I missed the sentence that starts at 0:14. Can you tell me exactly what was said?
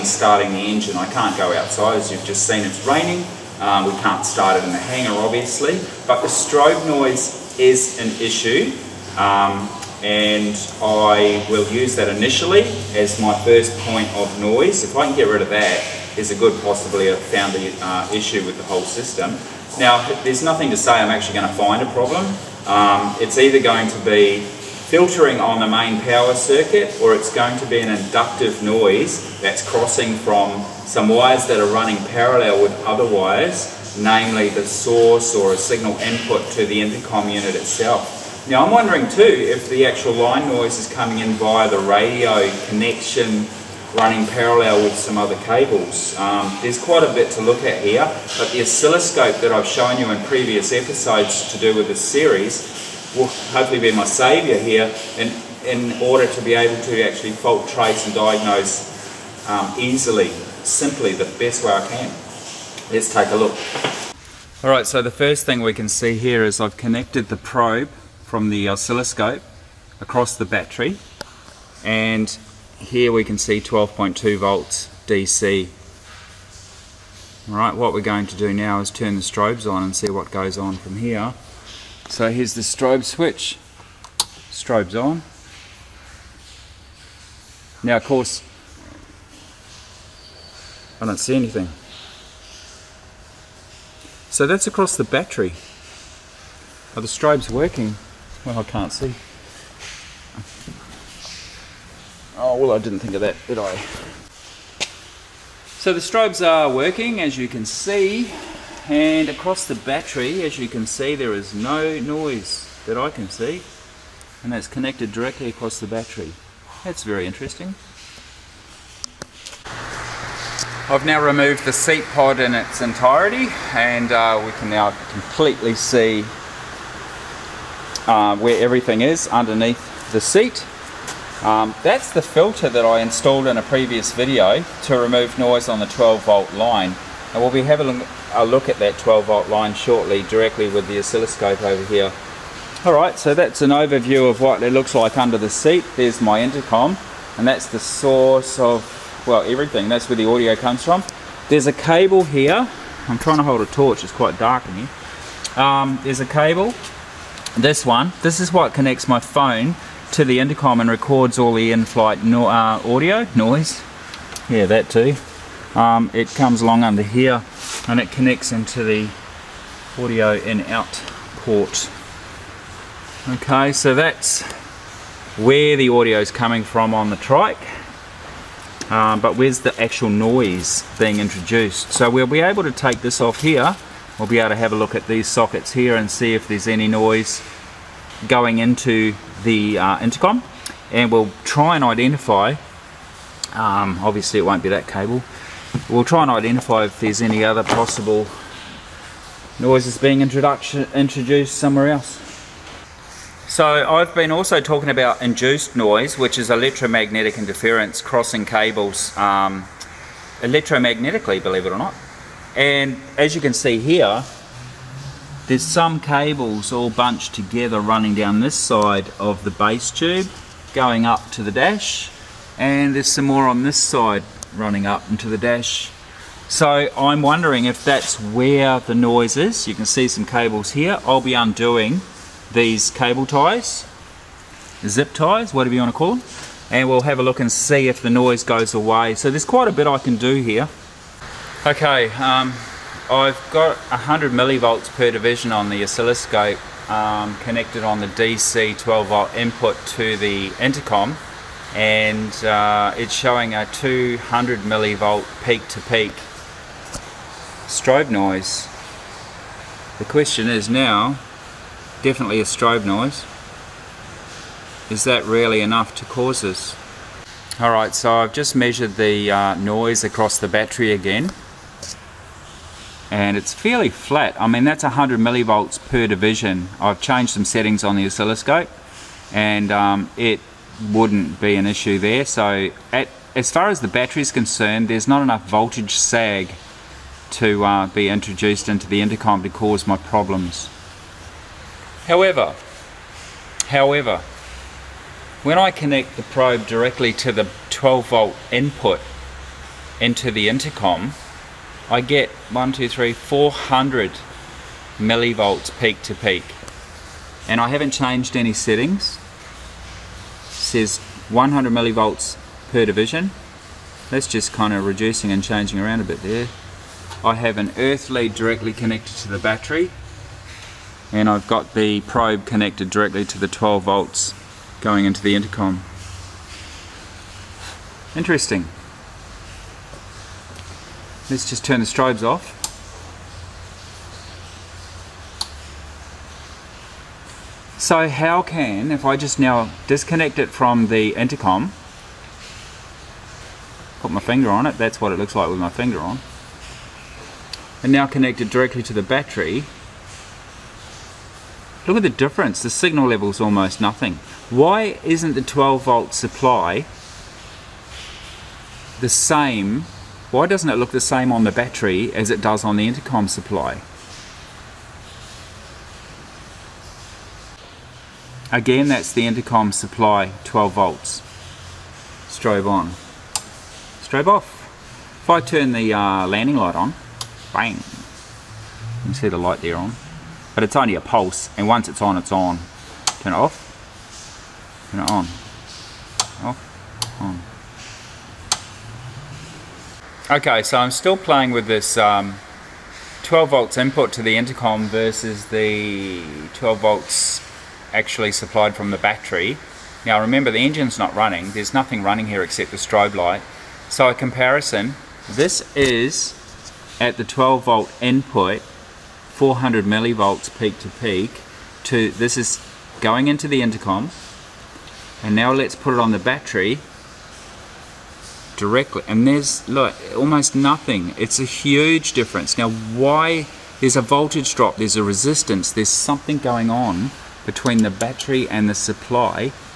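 If I can get rid of that, there's a good possibly a found the uh, issue with the whole system.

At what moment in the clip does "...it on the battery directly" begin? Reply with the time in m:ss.
6:55.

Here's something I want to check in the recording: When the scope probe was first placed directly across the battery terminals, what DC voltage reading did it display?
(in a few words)
12.2 volts.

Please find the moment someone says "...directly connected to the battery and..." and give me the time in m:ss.
5:18.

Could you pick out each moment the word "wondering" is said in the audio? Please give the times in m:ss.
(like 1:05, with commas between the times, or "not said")
0:38, 3:47.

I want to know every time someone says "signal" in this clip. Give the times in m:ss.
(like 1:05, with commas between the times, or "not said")
0:35, 5:52.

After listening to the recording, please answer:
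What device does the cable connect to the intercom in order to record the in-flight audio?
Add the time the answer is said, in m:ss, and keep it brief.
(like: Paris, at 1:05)
phone, at 2:39.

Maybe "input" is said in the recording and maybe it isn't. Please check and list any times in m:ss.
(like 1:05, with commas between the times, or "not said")
0:35, 4:09, 4:58, 6:33, 6:47.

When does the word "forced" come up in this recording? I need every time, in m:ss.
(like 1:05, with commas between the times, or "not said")
not said.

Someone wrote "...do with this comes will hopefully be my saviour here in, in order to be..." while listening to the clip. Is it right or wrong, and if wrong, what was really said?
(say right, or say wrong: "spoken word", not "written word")
wrong: "series", not "comes".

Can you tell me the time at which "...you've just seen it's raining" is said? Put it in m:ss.
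0:02.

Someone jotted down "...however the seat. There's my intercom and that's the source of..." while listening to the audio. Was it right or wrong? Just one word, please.
wrong.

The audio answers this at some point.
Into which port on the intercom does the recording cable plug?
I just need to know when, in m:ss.
2:49.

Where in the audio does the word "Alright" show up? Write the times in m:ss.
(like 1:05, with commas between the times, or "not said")
1:04, 1:17, 2:22, 4:27.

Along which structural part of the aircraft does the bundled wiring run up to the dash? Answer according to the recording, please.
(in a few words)
base tube.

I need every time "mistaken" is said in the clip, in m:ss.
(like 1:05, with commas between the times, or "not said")
not said.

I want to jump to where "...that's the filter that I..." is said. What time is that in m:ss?
2:11.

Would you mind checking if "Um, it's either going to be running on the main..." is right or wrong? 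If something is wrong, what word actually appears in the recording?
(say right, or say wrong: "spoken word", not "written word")
wrong: "filtering", not "running".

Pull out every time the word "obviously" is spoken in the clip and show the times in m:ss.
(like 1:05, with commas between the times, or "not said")
0:05, 3:14.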